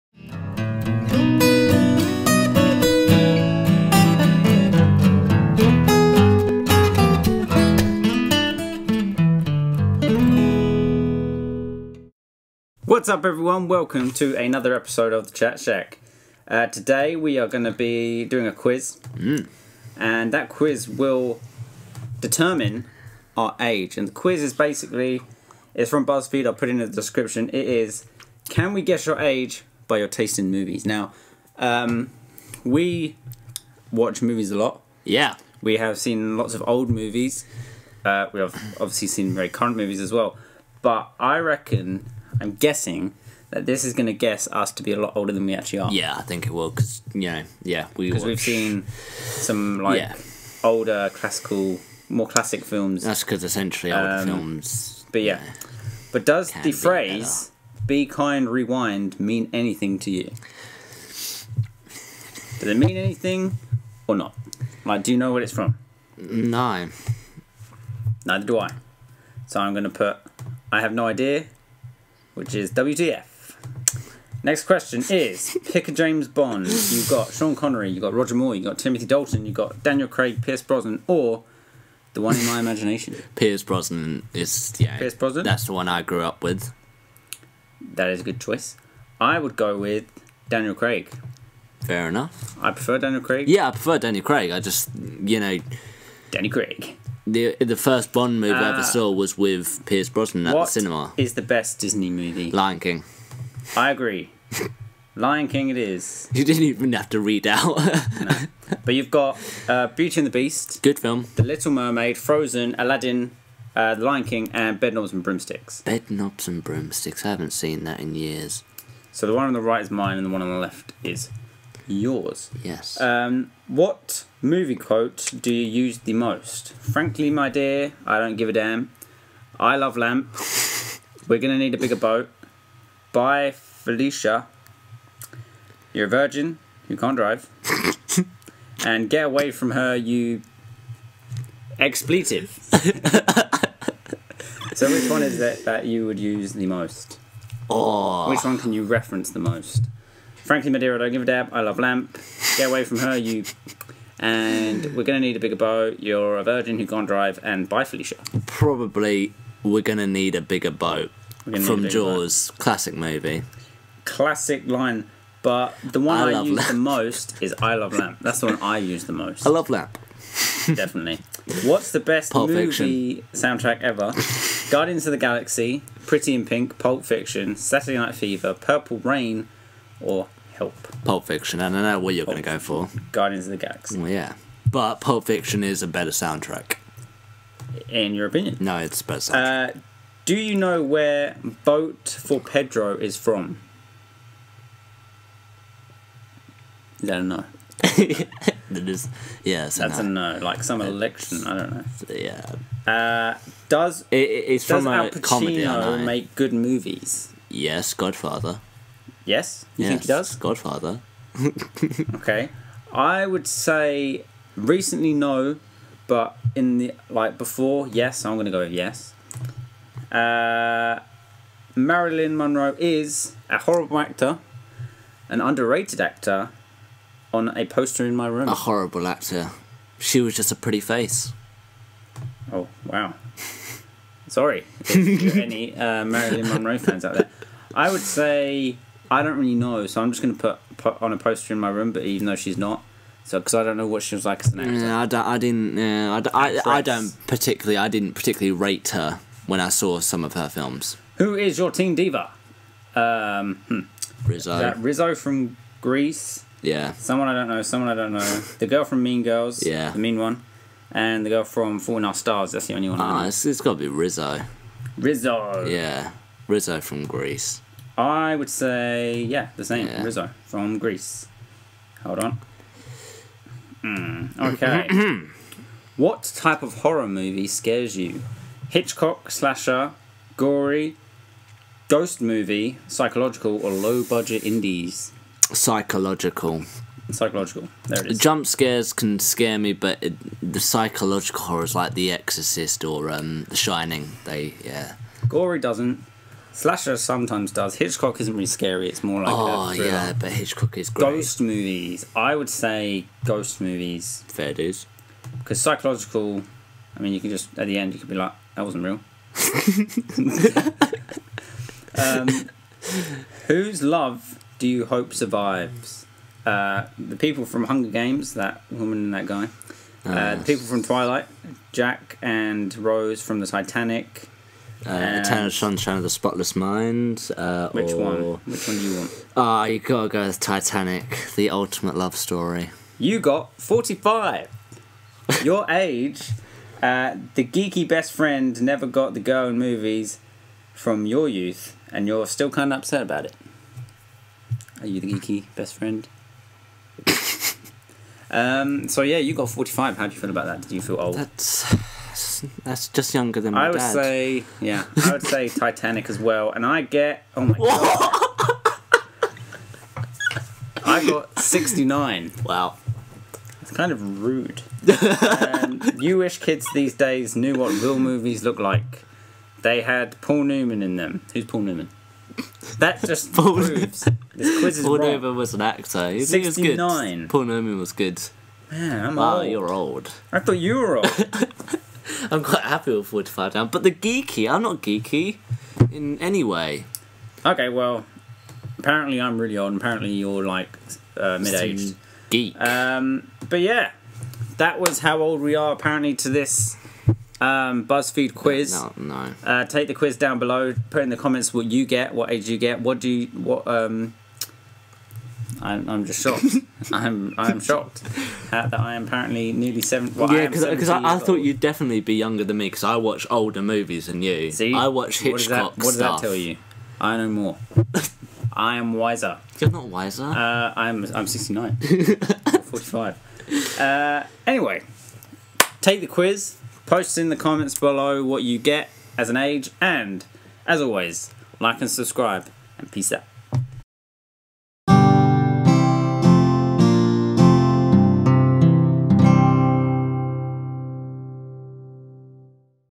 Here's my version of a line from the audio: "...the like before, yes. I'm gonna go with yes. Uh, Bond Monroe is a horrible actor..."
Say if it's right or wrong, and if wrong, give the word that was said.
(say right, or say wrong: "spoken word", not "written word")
wrong: "Marilyn", not "Bond".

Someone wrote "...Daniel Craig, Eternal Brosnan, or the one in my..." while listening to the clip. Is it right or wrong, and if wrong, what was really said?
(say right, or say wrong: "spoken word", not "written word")
wrong: "Pierce", not "Eternal".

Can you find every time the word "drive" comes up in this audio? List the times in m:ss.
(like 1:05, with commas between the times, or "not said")
2:17, 2:37.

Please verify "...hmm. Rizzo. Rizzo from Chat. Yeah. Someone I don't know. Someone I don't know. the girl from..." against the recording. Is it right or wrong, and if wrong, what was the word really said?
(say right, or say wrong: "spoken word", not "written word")
wrong: "Grease", not "Chat".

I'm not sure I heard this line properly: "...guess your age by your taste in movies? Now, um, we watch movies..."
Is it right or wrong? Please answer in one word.
right.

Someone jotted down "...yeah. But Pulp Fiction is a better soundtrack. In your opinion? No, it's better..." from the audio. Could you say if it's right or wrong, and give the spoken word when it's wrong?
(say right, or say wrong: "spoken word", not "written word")
right.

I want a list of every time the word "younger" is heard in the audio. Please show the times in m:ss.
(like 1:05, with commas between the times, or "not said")
5:53, 6:52.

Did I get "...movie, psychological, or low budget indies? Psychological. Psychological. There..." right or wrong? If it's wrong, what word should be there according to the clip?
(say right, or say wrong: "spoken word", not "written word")
right.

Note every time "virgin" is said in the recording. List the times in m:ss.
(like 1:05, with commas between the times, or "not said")
2:16, 2:36.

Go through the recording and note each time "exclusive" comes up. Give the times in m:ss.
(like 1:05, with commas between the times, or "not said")
not said.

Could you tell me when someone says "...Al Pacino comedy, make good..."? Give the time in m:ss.
3:24.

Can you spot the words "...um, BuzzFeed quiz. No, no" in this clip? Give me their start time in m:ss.
6:37.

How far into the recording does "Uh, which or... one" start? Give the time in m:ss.
5:27.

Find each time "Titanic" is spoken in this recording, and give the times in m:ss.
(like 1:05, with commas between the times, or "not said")
5:23, 5:30, 5:55.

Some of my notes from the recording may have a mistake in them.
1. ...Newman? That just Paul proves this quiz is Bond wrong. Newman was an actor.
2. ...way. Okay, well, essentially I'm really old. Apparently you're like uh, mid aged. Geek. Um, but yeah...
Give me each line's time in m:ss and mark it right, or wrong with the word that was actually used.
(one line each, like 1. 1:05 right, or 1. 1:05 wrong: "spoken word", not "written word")
1. 6:11 wrong: "Paul", not "Bond"
2. 6:26 wrong: "apparently", not "essentially".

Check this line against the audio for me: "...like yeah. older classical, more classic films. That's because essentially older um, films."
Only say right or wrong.
right.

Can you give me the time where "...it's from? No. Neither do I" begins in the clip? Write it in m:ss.
1:05.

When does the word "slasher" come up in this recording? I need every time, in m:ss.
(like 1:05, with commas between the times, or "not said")
4:39, 4:56.